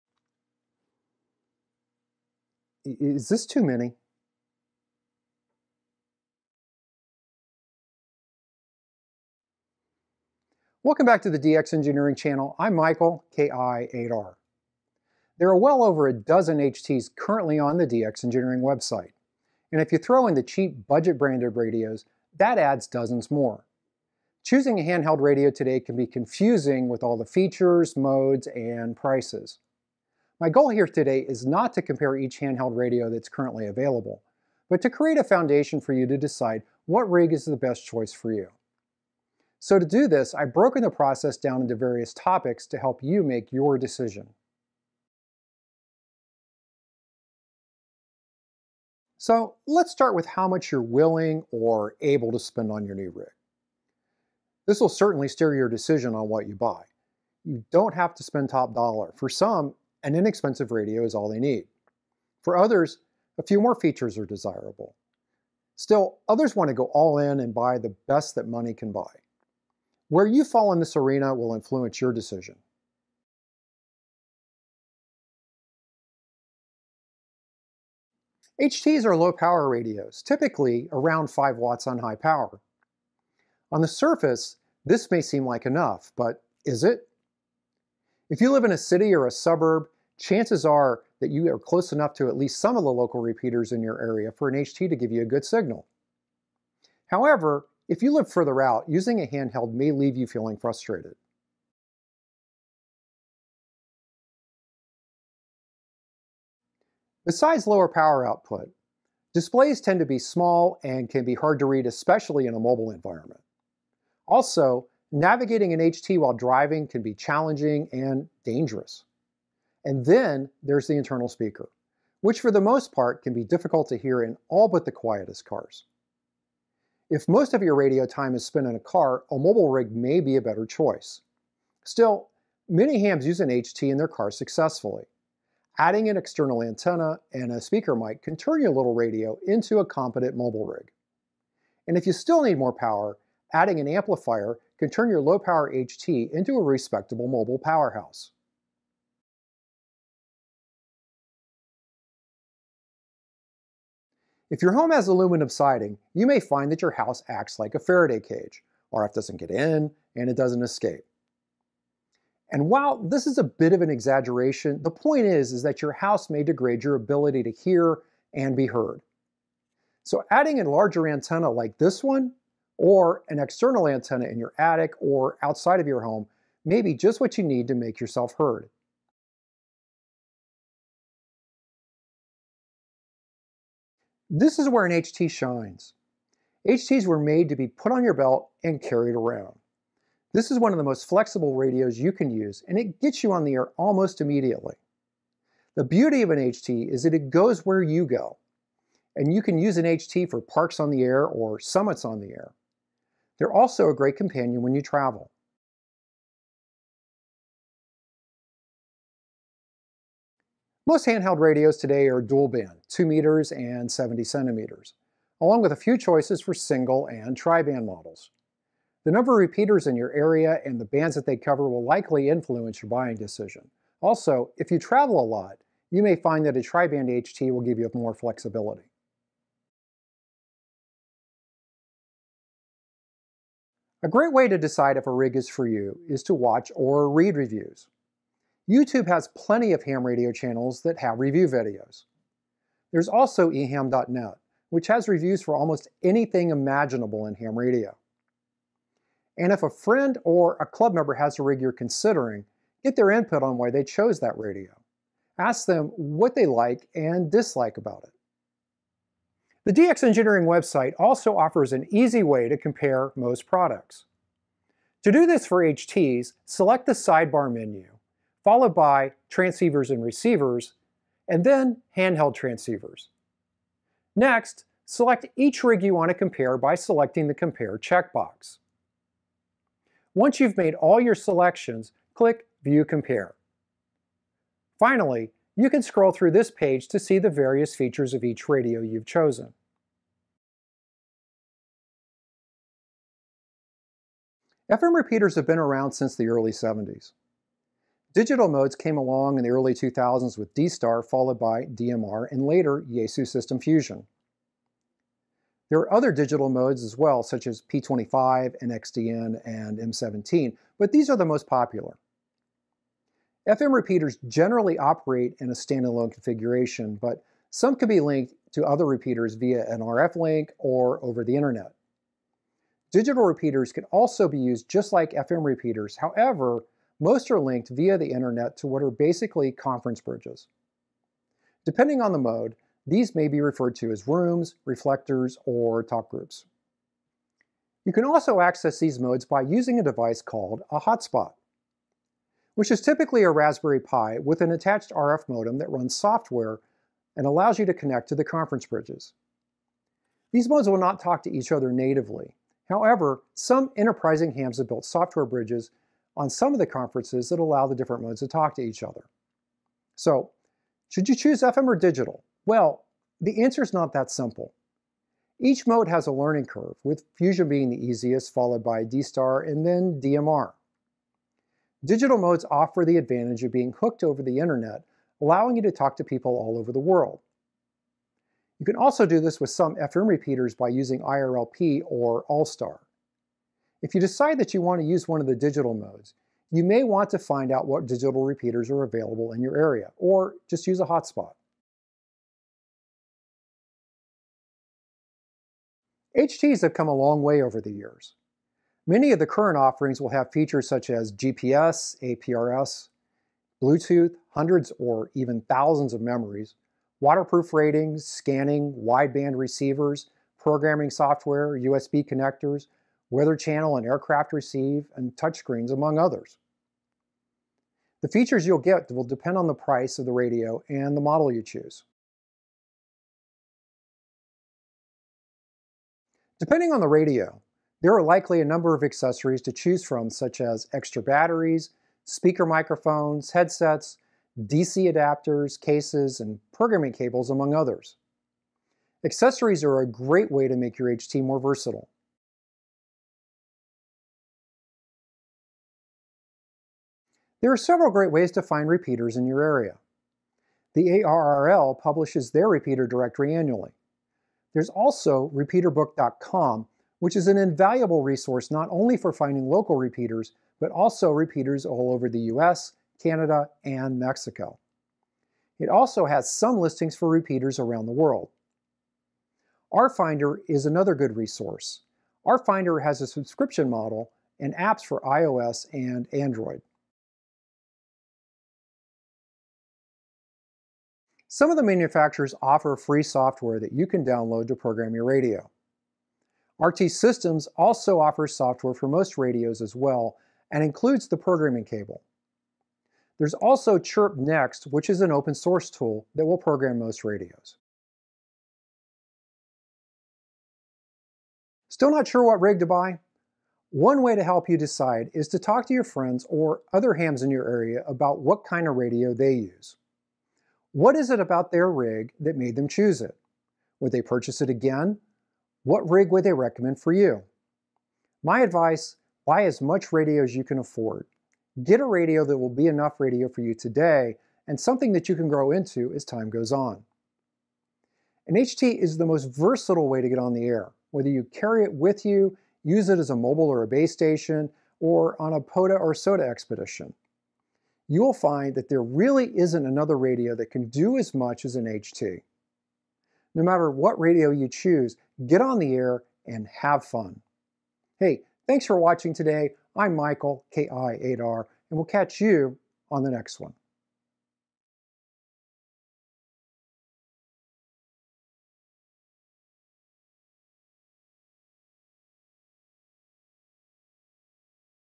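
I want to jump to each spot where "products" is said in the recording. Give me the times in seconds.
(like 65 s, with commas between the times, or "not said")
263 s.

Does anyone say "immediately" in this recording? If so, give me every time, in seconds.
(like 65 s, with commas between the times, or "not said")
194 s.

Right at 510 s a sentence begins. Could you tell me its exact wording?
What is it about their rig that made them choose it?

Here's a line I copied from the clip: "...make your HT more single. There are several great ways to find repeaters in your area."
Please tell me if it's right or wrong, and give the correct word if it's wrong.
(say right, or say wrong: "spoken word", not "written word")
wrong: "versatile", not "single".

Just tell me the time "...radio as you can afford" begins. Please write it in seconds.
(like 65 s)
519 s.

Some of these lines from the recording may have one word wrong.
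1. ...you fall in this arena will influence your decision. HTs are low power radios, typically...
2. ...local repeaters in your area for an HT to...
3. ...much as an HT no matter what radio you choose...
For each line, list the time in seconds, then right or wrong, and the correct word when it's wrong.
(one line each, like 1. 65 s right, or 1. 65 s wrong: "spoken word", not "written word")
1. 70 s right
2. 92 s right
3. 541 s right.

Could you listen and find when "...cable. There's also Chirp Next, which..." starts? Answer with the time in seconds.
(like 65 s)
491 s.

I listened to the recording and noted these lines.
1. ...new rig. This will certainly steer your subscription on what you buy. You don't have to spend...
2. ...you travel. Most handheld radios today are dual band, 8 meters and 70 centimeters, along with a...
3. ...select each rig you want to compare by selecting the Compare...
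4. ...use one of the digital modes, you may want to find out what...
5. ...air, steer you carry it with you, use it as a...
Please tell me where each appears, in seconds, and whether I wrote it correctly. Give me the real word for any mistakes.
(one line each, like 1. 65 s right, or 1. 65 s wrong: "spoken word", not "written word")
1. 52 s wrong: "decision", not "subscription"
2. 204 s wrong: "2", not "8"
3. 274 s right
4. 384 s right
5. 530 s wrong: "whether", not "steer".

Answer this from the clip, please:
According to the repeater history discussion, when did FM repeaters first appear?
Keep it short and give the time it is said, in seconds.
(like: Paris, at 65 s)
early 70s, at 296 s.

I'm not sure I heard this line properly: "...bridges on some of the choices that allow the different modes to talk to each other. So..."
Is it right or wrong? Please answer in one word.
wrong.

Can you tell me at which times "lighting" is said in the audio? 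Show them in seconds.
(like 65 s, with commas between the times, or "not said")
not said.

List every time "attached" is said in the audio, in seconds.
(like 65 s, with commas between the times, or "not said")
344 s.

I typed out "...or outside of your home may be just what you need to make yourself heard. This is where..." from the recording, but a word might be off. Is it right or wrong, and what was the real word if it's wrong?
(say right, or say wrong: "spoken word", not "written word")
right.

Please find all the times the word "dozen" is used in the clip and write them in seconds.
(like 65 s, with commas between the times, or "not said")
16 s, 22 s.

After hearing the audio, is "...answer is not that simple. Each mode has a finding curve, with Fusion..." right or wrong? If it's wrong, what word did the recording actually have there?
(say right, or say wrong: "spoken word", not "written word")
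wrong: "learning", not "finding".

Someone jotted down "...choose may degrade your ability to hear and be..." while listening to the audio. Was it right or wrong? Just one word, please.
wrong.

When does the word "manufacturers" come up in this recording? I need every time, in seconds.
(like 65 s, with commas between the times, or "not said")
481 s.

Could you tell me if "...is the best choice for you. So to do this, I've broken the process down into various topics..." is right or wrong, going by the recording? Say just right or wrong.
right.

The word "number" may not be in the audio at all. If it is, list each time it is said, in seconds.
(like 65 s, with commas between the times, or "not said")
219 s, 428 s.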